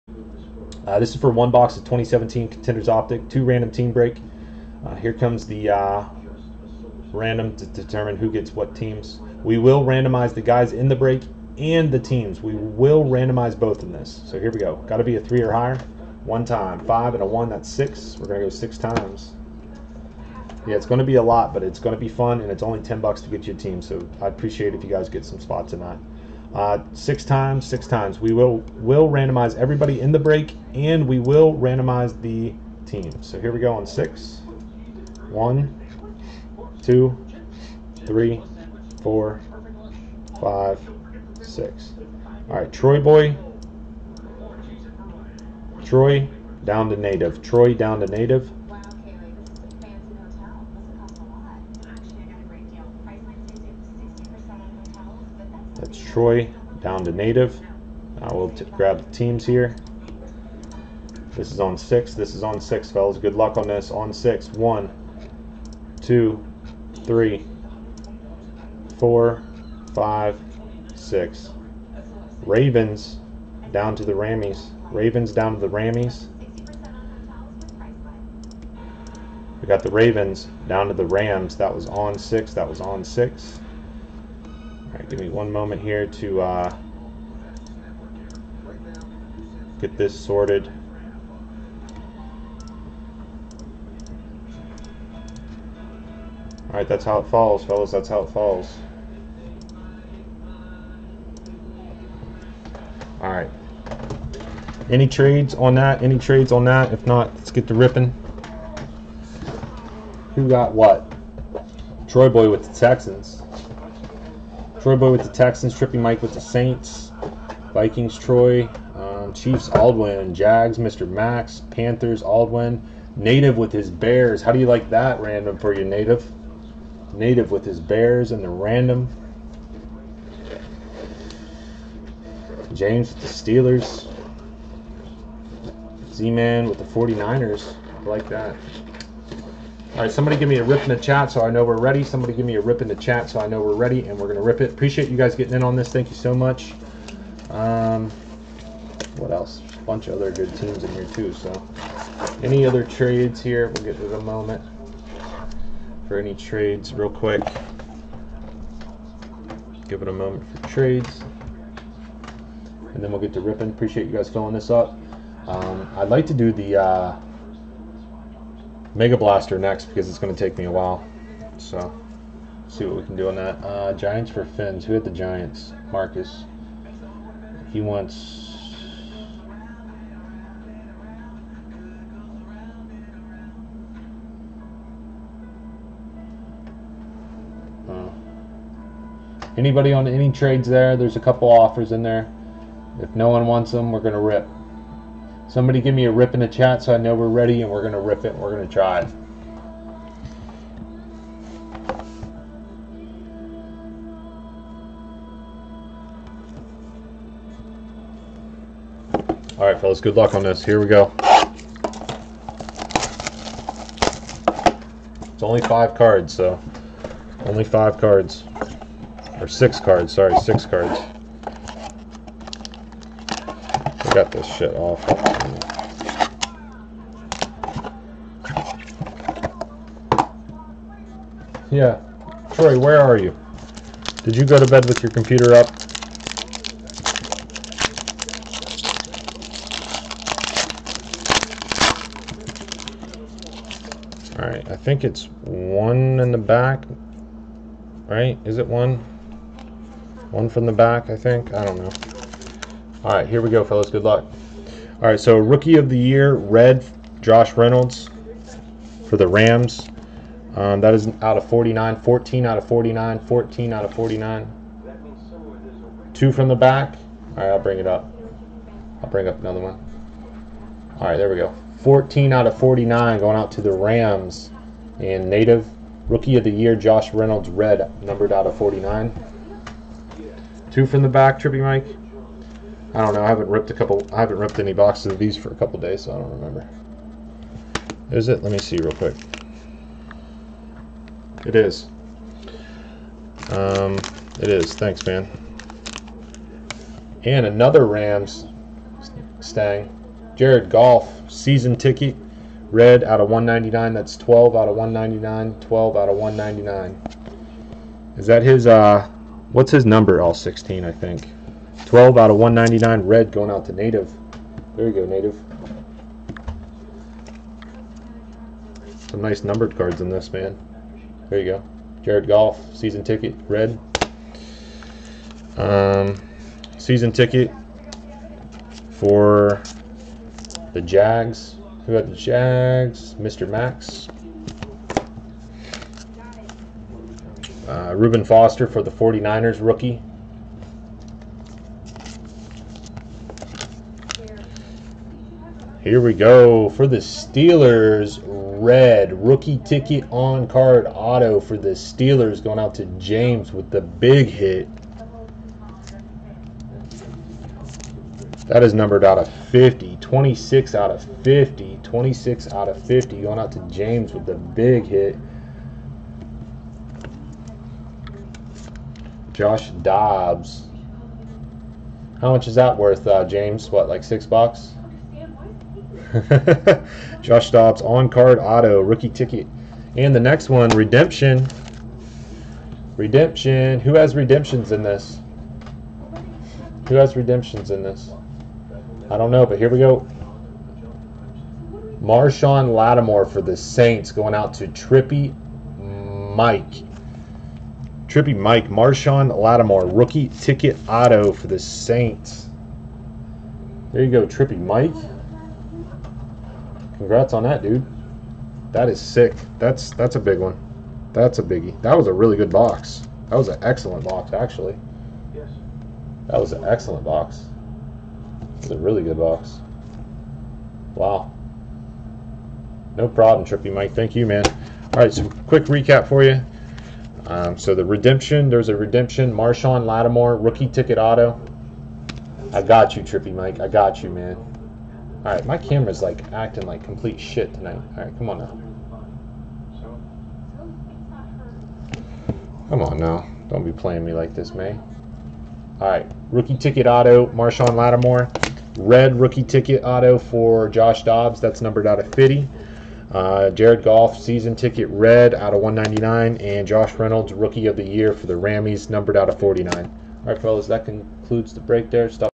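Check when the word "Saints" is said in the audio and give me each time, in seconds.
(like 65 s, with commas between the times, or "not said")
116 s, 393 s, 401 s.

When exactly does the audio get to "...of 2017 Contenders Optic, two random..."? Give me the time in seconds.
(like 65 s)
1 s.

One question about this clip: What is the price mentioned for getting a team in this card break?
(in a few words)
10 bucks.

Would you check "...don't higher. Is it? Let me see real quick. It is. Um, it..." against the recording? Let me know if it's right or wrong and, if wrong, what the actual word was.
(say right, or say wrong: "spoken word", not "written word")
wrong: "remember", not "higher".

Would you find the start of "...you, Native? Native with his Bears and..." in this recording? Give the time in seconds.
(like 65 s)
125 s.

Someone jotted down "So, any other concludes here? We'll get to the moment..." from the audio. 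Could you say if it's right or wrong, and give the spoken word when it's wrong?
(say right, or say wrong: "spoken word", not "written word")
wrong: "trades", not "concludes".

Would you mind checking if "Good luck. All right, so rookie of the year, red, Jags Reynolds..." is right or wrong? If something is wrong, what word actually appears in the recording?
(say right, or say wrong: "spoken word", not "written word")
wrong: "Josh", not "Jags".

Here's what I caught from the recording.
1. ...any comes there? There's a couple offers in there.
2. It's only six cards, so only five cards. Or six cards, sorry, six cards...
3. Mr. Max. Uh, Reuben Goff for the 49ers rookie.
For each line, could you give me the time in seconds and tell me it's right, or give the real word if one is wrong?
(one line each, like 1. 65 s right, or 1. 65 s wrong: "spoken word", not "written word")
1. 190 s wrong: "trades", not "comes"
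2. 215 s wrong: "five", not "six"
3. 333 s wrong: "Foster", not "Goff".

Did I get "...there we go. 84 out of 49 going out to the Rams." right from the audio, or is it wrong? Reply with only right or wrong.
wrong.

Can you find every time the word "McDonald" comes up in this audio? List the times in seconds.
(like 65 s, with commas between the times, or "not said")
not said.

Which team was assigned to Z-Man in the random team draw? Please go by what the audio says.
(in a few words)
49ers.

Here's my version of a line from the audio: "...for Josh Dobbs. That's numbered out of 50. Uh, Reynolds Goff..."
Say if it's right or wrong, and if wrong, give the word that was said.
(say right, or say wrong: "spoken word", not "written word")
wrong: "Jared", not "Reynolds".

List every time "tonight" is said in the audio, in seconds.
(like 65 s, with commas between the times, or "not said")
25 s, 437 s.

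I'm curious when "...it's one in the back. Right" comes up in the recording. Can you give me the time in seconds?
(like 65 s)
245 s.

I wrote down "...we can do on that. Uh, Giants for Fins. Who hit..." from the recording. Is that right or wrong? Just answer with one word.
right.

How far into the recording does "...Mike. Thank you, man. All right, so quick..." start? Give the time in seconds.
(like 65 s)
423 s.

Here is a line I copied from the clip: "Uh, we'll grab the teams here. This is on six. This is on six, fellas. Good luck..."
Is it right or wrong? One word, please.
right.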